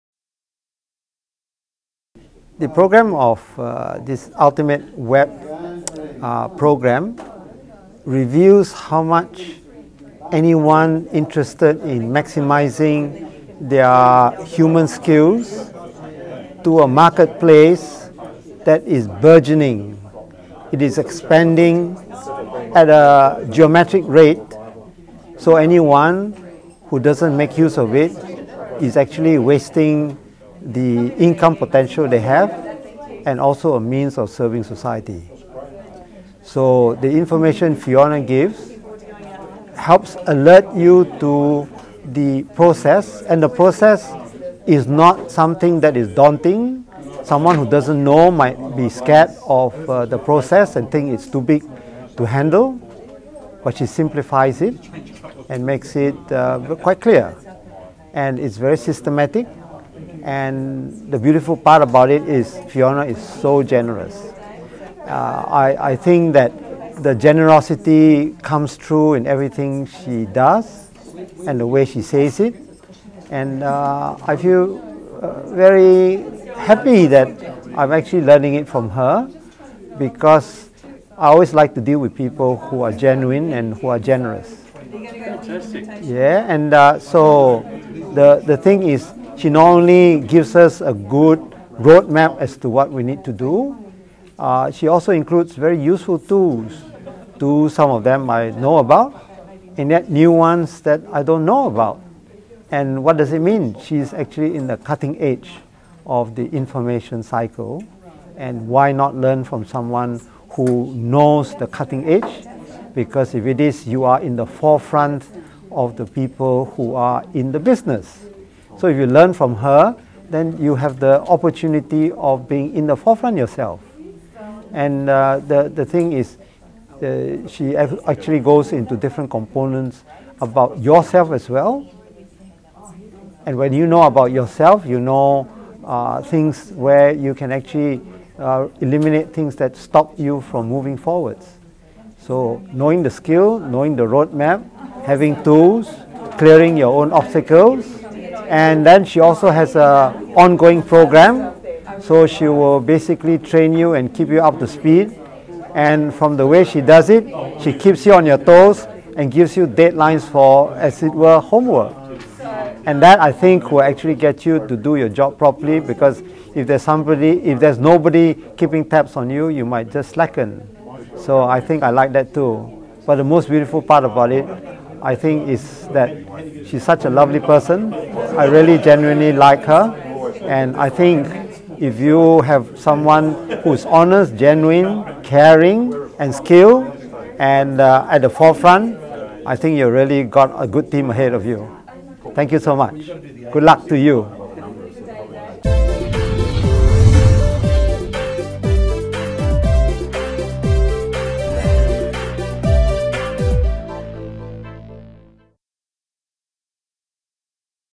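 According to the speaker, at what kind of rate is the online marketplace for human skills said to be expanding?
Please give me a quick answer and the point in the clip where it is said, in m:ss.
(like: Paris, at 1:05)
geometric rate, at 0:23.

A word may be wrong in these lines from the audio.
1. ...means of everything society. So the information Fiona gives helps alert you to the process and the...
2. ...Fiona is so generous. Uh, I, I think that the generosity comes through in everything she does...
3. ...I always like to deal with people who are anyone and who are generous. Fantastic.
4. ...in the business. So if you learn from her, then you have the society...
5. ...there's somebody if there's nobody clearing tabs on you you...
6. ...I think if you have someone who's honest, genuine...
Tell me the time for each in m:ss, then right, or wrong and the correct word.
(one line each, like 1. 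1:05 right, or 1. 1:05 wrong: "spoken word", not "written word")
1. 0:33 wrong: "serving", not "everything"
2. 1:02 right
3. 1:21 wrong: "genuine", not "anyone"
4. 1:57 wrong: "opportunity", not "society"
5. 2:46 wrong: "keeping", not "clearing"
6. 3:00 right.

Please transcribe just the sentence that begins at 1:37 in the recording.
To some of them I know about, and yet new ones that I don't know about.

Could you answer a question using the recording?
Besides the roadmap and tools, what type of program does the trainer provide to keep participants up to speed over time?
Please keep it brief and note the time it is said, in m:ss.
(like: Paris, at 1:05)
ongoing program, at 2:30.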